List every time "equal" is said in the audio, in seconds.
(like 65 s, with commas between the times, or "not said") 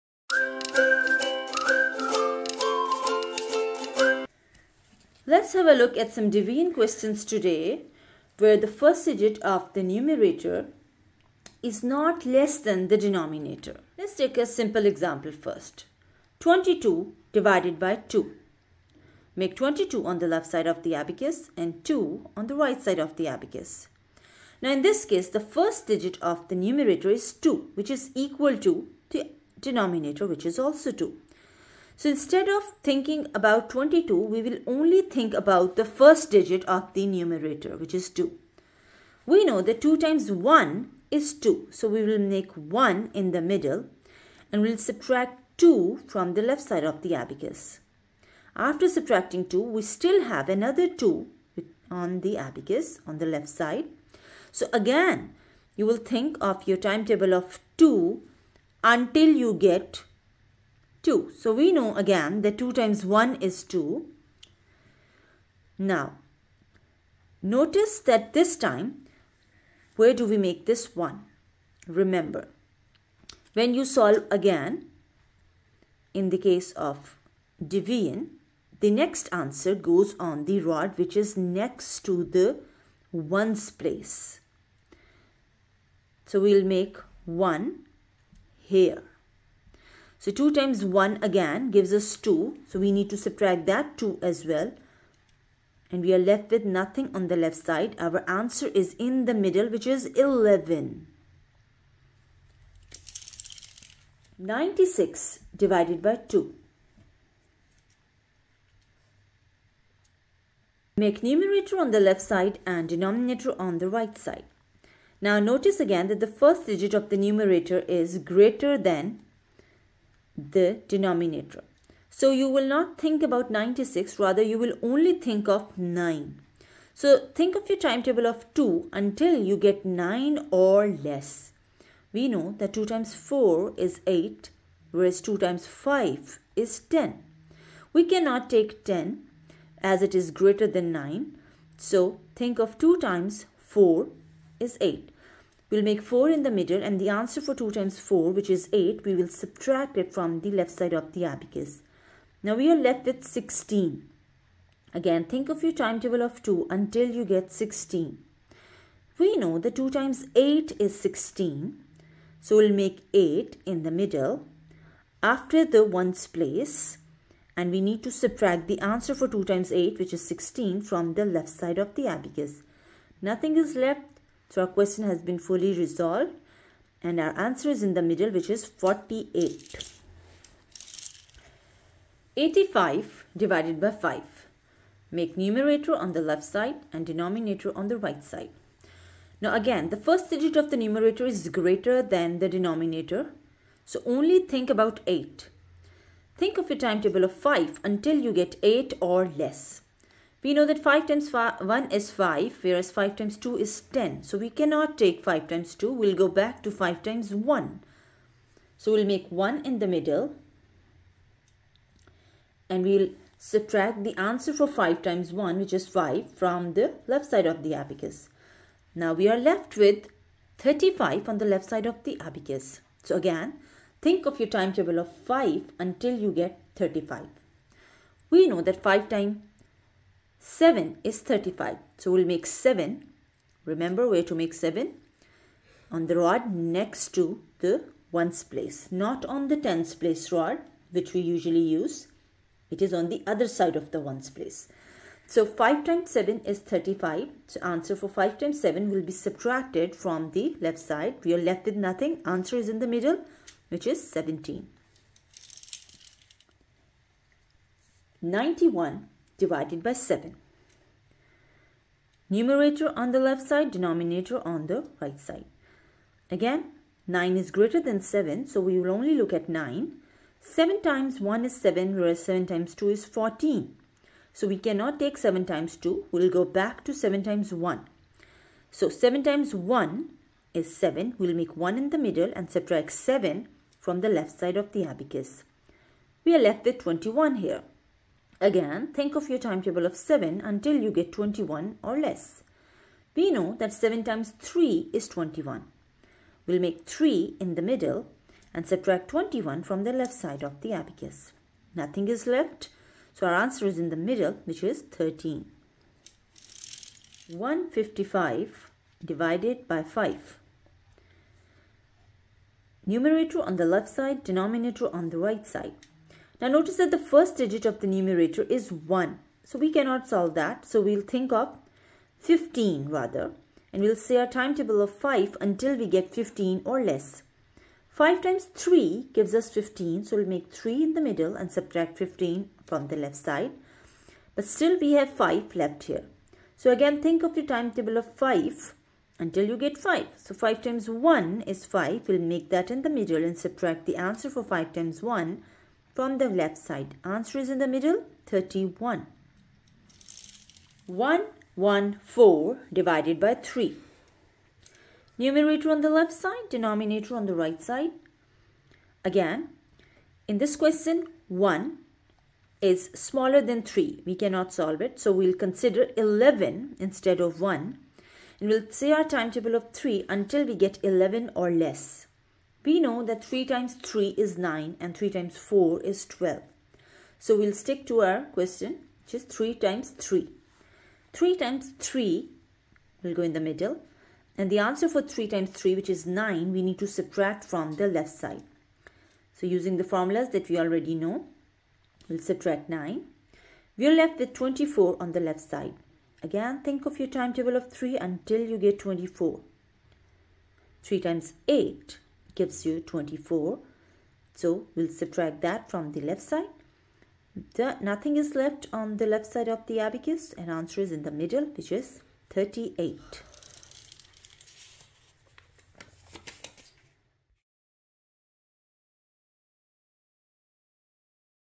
28 s.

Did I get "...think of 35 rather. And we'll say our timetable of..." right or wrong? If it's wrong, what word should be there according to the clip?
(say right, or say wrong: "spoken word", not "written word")
wrong: "15", not "35".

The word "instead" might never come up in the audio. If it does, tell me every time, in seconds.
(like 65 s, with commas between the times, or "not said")
32 s, 366 s.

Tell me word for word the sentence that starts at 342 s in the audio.
We'll make that in the middle and subtract the answer for 5 times 1 from the left side.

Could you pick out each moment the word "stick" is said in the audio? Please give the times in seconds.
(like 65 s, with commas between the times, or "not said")
377 s.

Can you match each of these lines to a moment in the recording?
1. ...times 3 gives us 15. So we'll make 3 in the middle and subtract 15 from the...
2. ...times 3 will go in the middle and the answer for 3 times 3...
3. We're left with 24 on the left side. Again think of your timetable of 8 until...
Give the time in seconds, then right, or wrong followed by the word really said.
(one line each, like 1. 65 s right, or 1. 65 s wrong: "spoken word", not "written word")
1. 328 s right
2. 381 s right
3. 393 s wrong: "3", not "8".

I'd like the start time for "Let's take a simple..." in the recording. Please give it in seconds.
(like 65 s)
13 s.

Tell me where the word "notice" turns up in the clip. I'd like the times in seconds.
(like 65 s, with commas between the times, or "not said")
67 s, 115 s, 316 s.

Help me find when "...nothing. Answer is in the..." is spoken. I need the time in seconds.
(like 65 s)
251 s.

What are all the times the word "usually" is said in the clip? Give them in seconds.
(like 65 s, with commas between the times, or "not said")
241 s.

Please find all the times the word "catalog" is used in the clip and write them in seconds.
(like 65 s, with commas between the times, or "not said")
not said.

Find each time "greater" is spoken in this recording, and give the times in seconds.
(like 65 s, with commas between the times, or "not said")
118 s, 140 s, 191 s, 267 s.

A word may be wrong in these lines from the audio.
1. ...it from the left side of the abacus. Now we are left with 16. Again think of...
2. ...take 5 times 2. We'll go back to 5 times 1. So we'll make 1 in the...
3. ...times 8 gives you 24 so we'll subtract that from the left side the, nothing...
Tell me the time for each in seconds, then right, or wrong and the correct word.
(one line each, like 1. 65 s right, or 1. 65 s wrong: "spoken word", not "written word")
1. 150 s right
2. 204 s right
3. 400 s right.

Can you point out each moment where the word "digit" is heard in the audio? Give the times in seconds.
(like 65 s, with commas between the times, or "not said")
9 s, 25 s, 36 s, 116 s, 190 s, 317 s.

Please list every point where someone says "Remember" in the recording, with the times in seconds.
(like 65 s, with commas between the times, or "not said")
71 s, 233 s.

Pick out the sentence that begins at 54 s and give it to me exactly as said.
So again, you will think of your timetable of 2 until you get 2.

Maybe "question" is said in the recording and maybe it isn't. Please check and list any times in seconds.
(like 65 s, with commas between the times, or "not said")
6 s, 174 s, 360 s, 378 s.